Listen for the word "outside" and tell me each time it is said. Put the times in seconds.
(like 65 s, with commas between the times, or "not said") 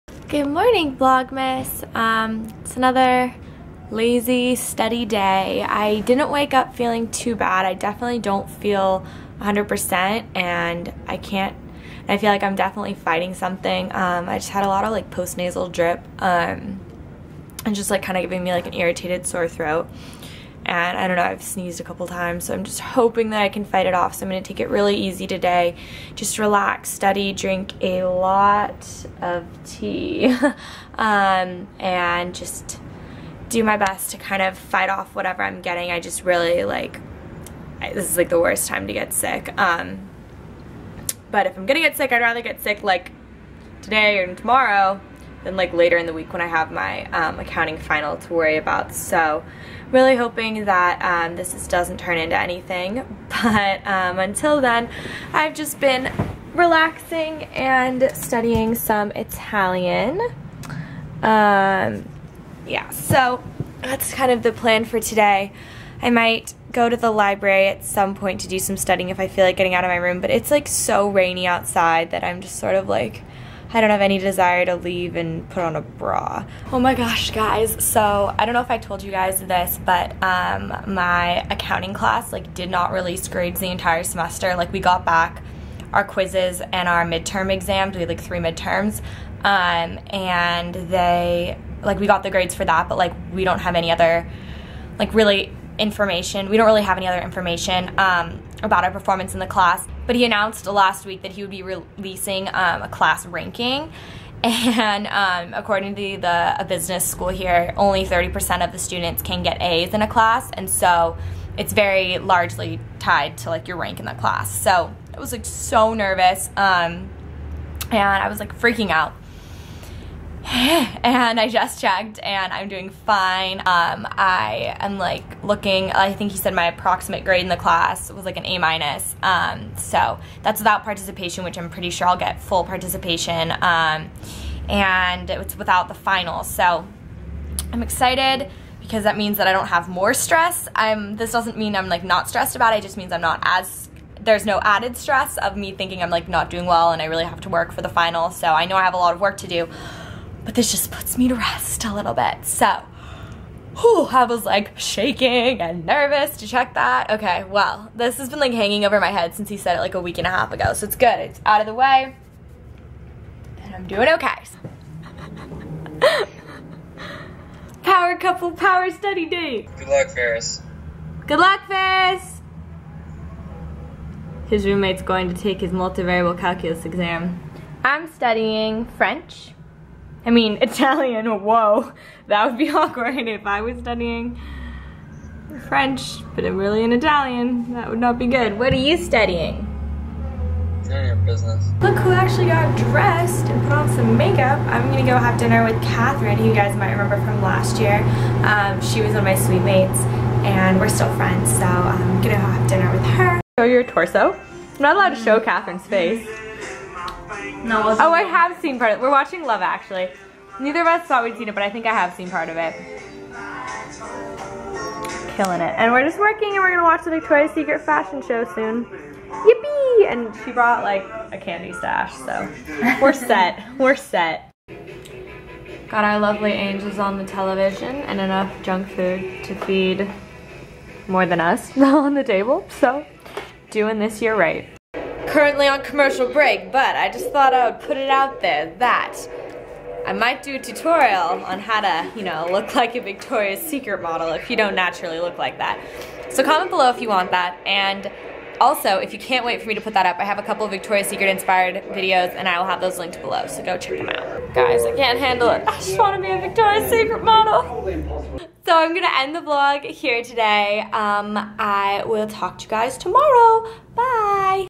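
71 s.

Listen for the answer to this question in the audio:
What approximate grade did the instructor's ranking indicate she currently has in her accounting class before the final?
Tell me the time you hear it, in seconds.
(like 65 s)
128 s.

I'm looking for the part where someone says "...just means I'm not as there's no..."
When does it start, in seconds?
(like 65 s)
142 s.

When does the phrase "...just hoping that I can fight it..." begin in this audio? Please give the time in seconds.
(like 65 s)
22 s.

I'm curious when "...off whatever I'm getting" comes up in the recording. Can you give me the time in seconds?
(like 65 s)
34 s.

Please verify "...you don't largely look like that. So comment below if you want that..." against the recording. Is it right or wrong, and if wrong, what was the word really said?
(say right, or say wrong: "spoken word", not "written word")
wrong: "naturally", not "largely".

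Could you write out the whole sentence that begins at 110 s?
And so it's very largely tied to like your rank in the class.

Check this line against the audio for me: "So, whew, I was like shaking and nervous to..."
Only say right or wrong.
right.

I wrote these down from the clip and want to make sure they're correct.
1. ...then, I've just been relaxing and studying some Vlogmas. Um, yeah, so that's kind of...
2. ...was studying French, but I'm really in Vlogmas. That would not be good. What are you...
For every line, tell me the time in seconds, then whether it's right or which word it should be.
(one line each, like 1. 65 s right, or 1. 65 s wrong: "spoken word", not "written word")
1. 54 s wrong: "Italian", not "Vlogmas"
2. 183 s wrong: "Italian", not "Vlogmas".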